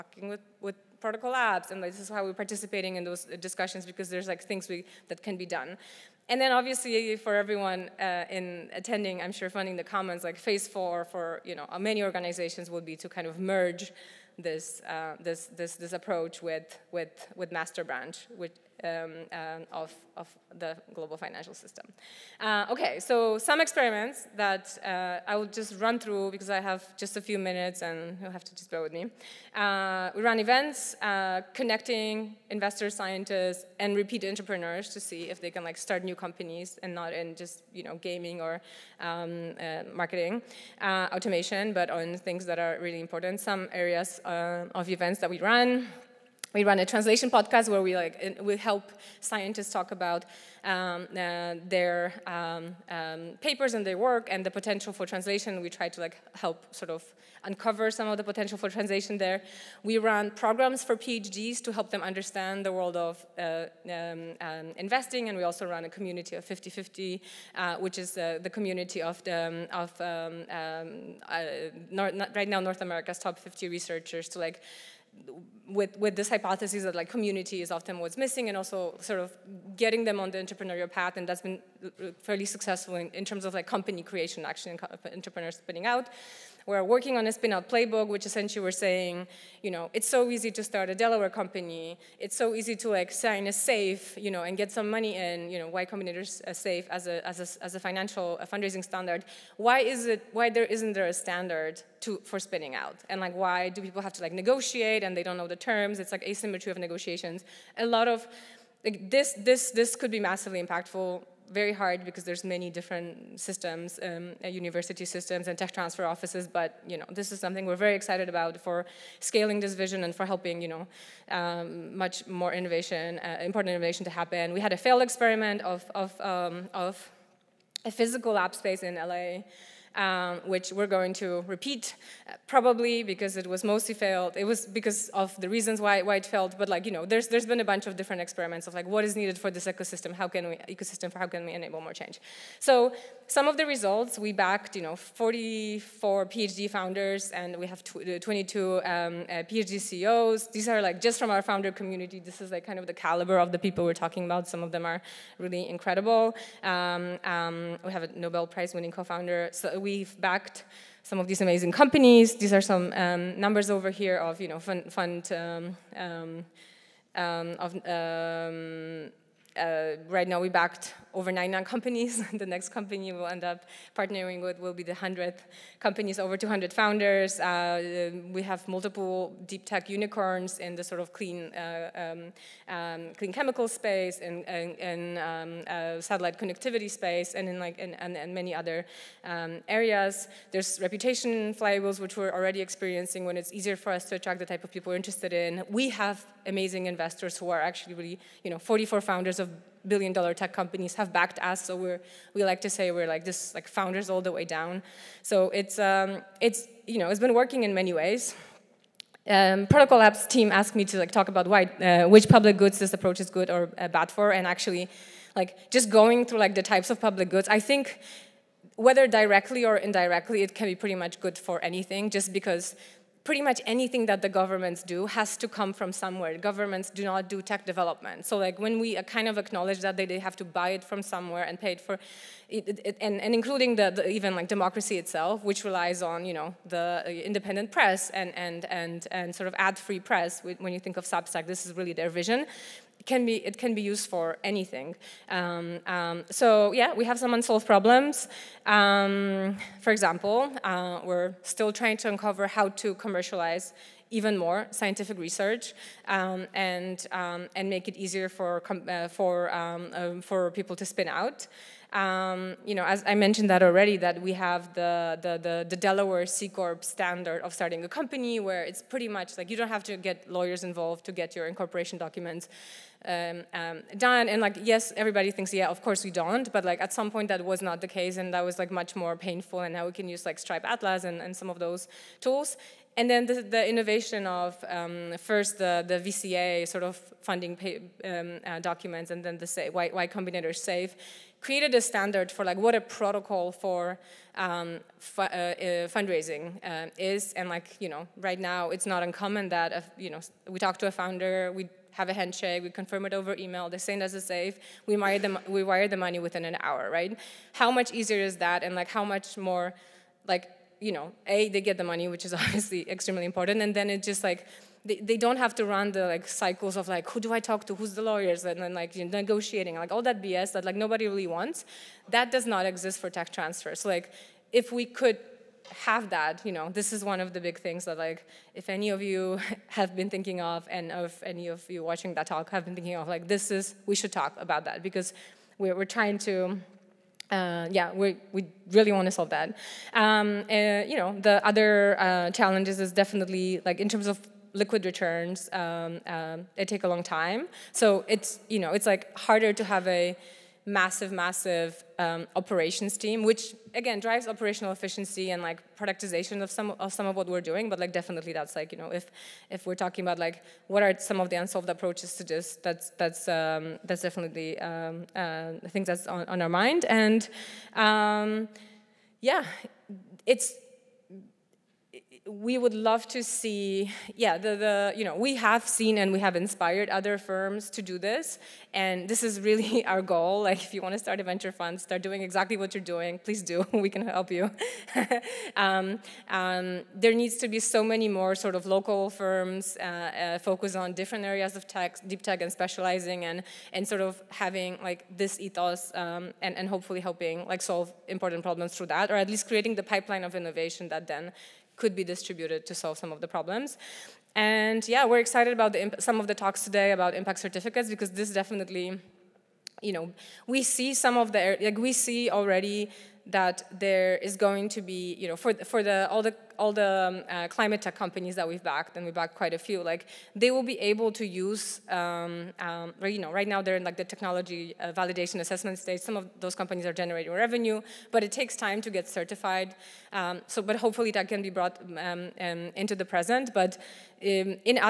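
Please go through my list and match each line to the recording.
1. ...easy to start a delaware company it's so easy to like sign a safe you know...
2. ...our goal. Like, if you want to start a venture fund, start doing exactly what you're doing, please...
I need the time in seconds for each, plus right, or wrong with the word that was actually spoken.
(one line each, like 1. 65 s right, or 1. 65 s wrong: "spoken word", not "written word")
1. 90 s right
2. 379 s right.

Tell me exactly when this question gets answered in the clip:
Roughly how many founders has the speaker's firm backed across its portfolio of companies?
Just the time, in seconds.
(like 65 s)
176 s.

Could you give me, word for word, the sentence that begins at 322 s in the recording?
That does not exist for tech transfers.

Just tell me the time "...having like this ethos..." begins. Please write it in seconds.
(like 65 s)
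394 s.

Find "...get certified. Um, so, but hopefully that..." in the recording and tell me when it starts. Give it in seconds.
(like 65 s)
428 s.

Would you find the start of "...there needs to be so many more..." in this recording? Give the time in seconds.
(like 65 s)
386 s.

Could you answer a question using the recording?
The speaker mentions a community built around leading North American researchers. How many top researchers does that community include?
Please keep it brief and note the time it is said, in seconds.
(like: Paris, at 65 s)
50, at 73 s.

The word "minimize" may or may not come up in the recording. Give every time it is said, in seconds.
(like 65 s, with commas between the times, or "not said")
not said.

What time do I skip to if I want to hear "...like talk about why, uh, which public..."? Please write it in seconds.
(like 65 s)
210 s.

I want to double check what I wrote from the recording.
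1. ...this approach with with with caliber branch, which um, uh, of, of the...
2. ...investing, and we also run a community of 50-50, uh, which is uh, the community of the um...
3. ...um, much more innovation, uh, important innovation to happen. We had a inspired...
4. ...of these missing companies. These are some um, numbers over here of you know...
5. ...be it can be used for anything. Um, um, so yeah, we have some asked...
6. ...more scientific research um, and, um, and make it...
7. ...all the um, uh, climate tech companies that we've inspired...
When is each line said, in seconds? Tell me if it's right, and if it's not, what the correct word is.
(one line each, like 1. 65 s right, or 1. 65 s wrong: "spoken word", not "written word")
1. 15 s wrong: "master", not "caliber"
2. 64 s right
3. 121 s wrong: "failed", not "inspired"
4. 161 s wrong: "amazing", not "missing"
5. 243 s wrong: "unsolved", not "asked"
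6. 254 s right
7. 416 s wrong: "backed", not "inspired".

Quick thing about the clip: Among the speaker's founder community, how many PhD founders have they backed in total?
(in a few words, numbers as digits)
44.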